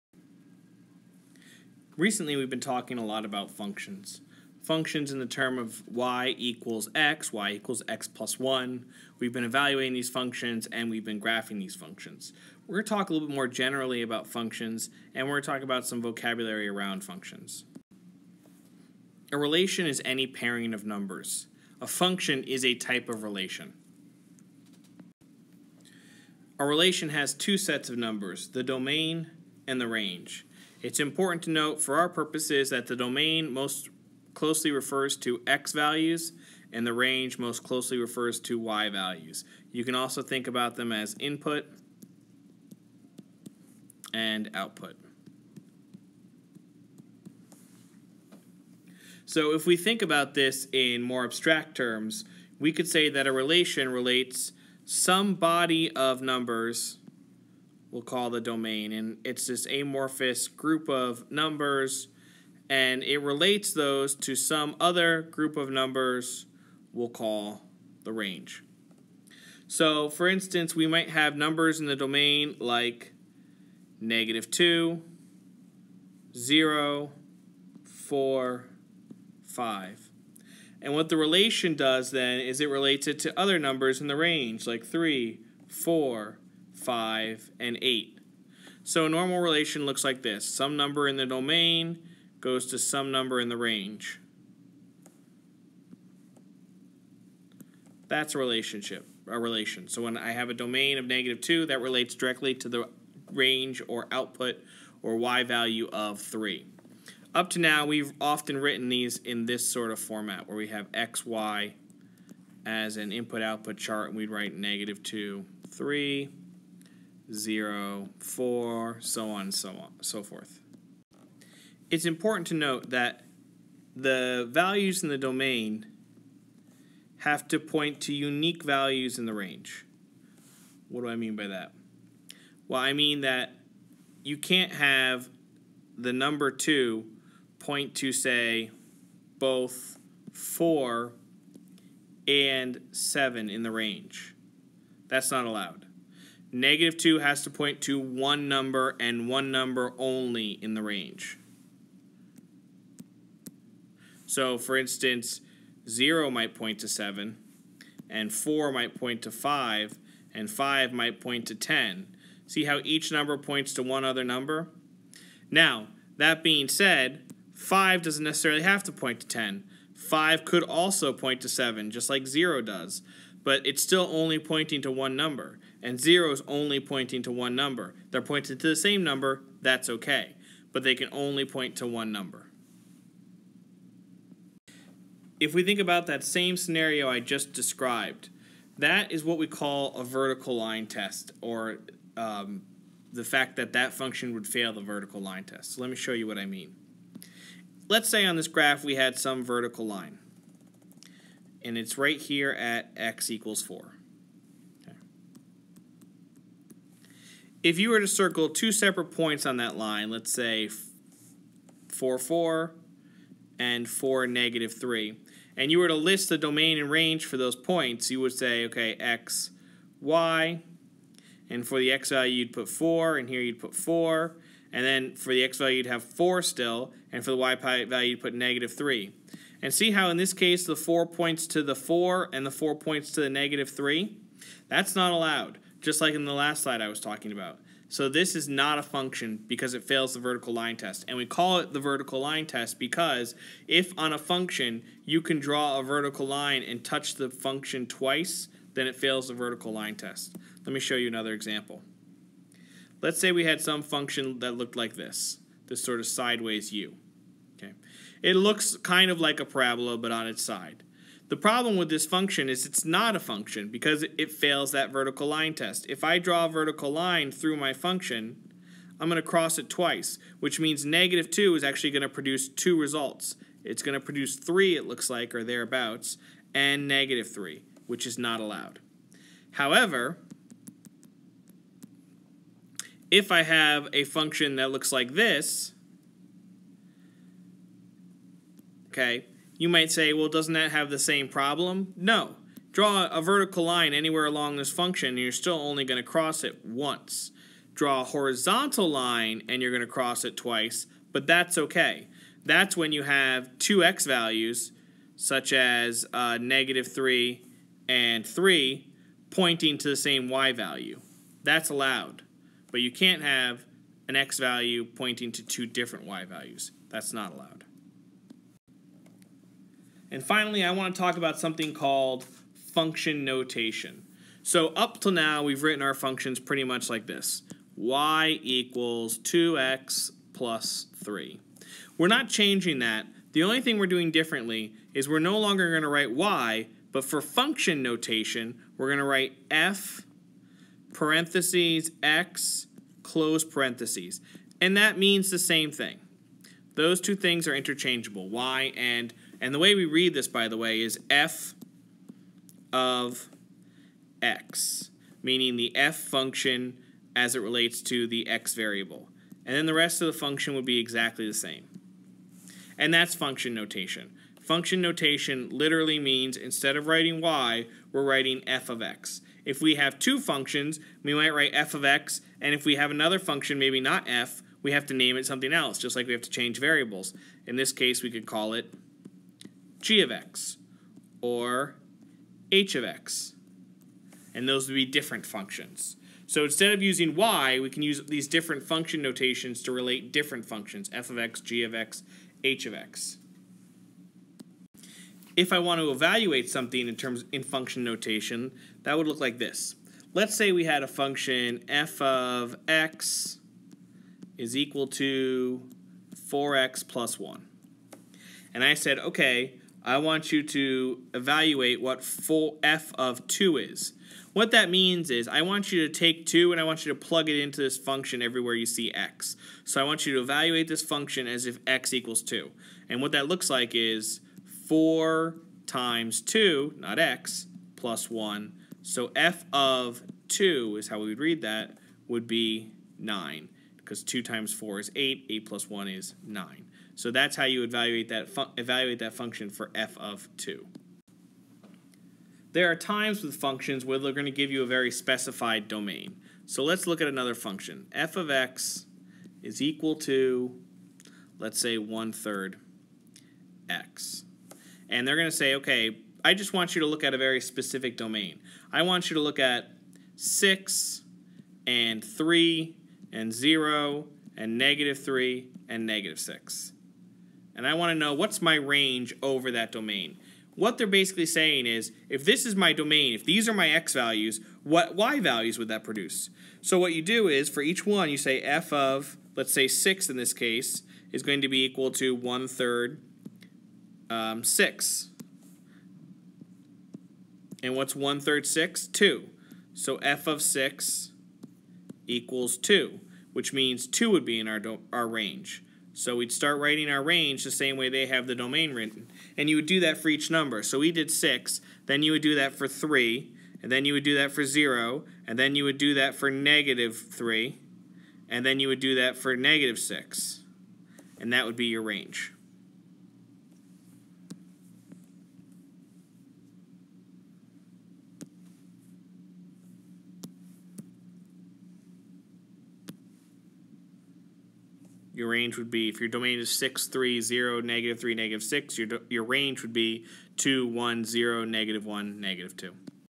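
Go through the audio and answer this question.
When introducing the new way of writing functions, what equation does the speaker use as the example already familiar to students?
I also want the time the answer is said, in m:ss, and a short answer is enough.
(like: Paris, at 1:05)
y = 2x + 3, at 5:27.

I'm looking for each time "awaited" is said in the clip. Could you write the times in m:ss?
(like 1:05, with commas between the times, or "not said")
not said.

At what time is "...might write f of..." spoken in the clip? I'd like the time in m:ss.
6:11.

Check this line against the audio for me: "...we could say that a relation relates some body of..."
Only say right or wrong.
right.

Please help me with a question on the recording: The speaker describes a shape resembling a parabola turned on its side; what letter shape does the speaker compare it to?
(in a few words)
sideways u.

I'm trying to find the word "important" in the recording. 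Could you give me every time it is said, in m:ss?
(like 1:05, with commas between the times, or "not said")
0:30, 2:02.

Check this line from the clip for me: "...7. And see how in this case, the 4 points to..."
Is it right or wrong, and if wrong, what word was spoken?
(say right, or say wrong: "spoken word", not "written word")
wrong: "3", not "7".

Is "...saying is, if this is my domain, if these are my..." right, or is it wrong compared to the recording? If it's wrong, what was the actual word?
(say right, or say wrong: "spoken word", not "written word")
right.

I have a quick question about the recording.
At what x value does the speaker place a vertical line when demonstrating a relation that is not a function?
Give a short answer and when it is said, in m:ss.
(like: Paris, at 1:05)
x equals 4, at 3:22.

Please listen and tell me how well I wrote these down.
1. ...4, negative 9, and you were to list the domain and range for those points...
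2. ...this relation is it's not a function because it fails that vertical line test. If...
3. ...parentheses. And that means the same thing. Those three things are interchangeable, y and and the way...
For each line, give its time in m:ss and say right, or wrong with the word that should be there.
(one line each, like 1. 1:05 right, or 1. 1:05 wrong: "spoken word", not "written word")
1. 3:33 wrong: "3", not "9"
2. 4:21 wrong: "function", not "relation"
3. 5:43 wrong: "two", not "three".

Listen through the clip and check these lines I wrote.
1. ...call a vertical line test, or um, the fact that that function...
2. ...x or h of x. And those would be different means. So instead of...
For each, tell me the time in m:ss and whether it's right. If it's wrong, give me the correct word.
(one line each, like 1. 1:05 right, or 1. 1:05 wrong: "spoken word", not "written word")
1. 3:09 right
2. 6:20 wrong: "functions", not "means".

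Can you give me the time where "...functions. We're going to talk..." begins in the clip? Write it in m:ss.
0:11.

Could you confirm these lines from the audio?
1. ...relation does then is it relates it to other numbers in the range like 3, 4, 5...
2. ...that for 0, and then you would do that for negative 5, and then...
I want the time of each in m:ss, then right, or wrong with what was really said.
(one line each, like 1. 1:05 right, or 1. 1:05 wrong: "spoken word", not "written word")
1. 1:21 right
2. 8:24 wrong: "3", not "5".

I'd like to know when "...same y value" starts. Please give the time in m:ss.
5:09.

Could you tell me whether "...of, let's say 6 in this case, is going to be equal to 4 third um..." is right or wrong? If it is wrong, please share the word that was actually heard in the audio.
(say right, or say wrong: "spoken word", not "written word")
wrong: "1", not "4".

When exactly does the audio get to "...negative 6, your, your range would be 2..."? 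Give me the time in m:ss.
8:48.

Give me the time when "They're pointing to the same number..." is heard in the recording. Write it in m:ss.
2:58.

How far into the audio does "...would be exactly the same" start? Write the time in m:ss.
6:00.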